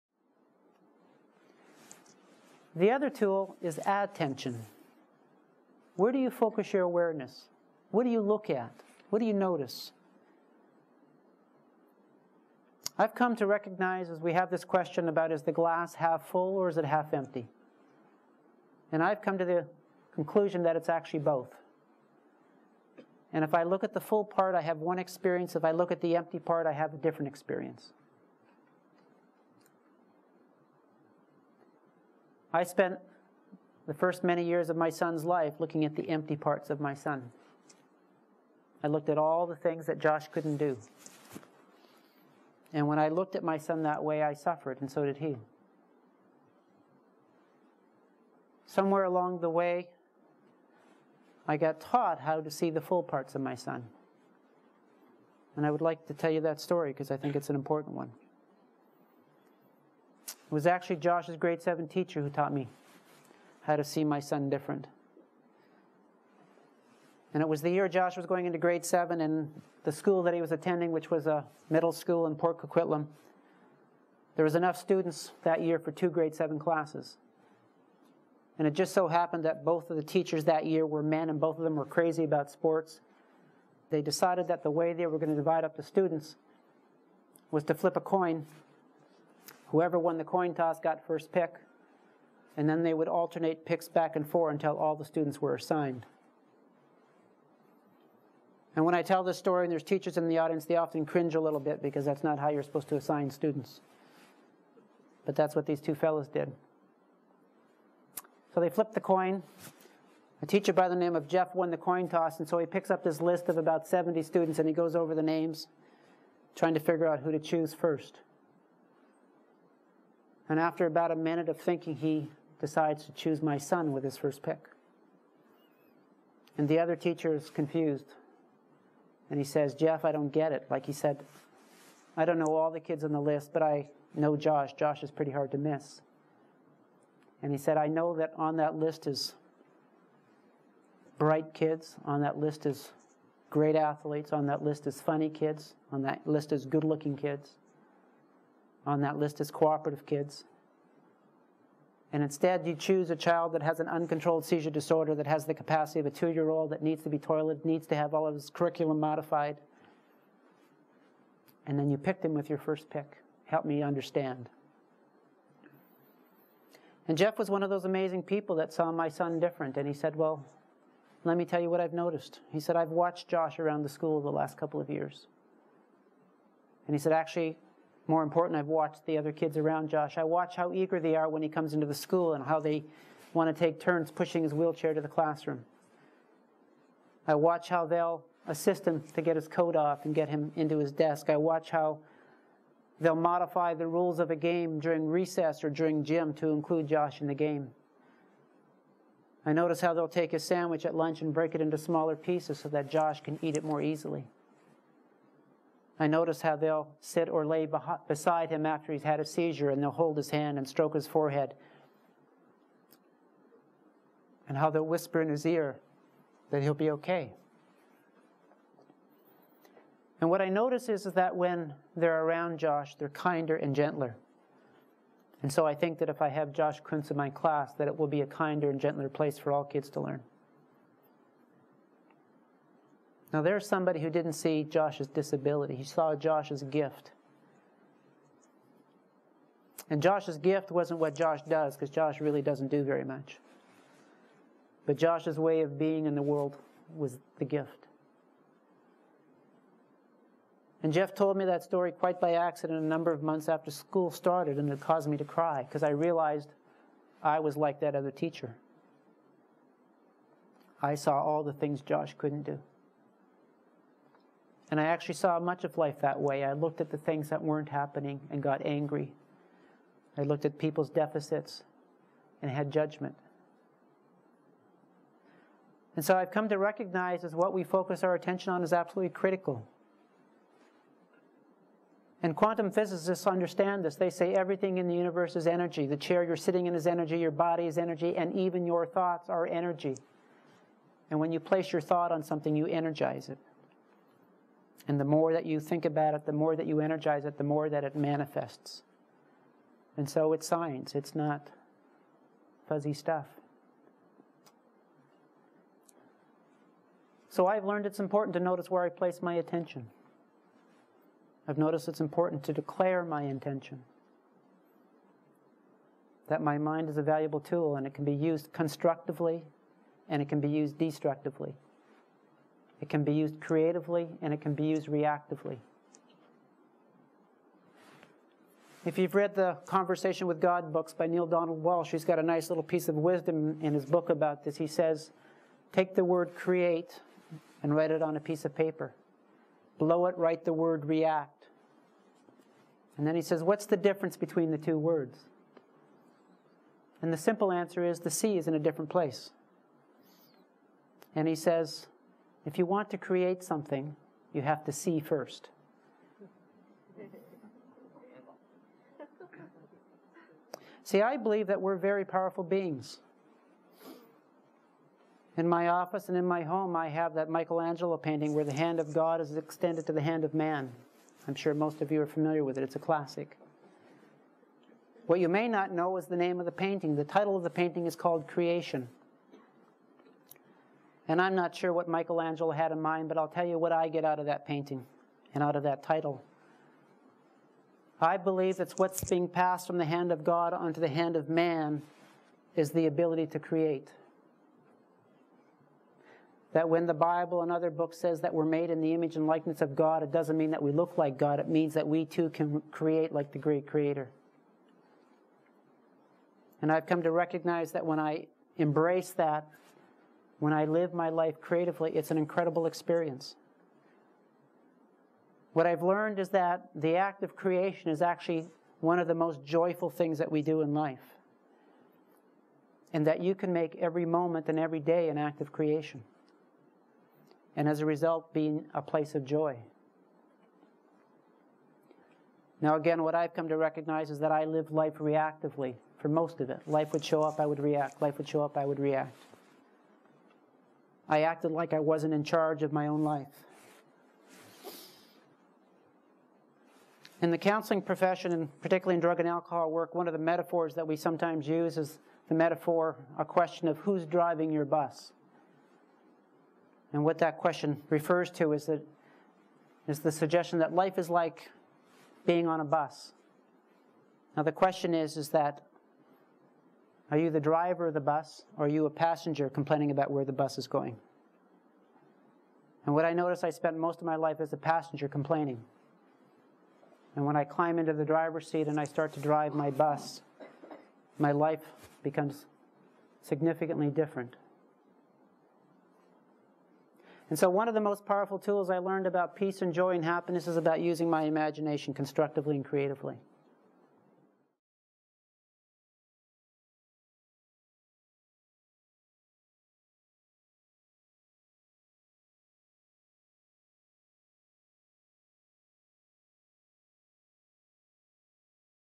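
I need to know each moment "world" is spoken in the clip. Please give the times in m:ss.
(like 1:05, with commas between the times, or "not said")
4:06.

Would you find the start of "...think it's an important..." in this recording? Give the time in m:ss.
0:57.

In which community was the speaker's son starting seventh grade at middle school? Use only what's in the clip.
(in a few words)
Port Coquitlam.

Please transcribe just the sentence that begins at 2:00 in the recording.
And after about a minute of thinking, he decides to choose my son with his first pick.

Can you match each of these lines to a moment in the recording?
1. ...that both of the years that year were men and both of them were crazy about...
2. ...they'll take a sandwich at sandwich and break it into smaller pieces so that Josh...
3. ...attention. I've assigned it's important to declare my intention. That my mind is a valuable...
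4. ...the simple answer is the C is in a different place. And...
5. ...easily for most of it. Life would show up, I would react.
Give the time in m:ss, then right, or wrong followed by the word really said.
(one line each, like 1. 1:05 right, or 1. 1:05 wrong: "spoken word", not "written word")
1. 1:19 wrong: "teachers", not "years"
2. 3:19 wrong: "lunch", not "sandwich"
3. 5:09 wrong: "noticed", not "assigned"
4. 5:47 right
5. 7:14 wrong: "reactively", not "easily".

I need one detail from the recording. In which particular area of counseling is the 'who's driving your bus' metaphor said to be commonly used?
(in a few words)
drug and alcohol work.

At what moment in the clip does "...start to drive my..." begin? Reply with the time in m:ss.
7:58.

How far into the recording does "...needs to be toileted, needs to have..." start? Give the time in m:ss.
2:36.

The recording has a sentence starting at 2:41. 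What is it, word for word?
And then you pick him with your first pick.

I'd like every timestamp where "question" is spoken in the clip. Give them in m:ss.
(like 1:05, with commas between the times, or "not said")
0:14, 7:33, 7:37, 7:44.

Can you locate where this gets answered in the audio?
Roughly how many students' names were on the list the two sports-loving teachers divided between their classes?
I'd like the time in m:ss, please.
1:53.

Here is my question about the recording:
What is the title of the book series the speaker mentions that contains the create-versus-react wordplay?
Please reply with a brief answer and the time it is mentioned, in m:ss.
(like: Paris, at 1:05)
Conversation with God, at 5:29.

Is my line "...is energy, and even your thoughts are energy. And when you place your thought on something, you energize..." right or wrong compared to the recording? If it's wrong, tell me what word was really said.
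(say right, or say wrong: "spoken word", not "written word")
right.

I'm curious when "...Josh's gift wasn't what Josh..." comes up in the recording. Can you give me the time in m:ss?
4:00.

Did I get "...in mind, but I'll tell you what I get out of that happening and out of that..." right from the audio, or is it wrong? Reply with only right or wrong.
wrong.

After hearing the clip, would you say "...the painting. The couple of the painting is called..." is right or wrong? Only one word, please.
wrong.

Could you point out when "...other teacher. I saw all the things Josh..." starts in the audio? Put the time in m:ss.
4:17.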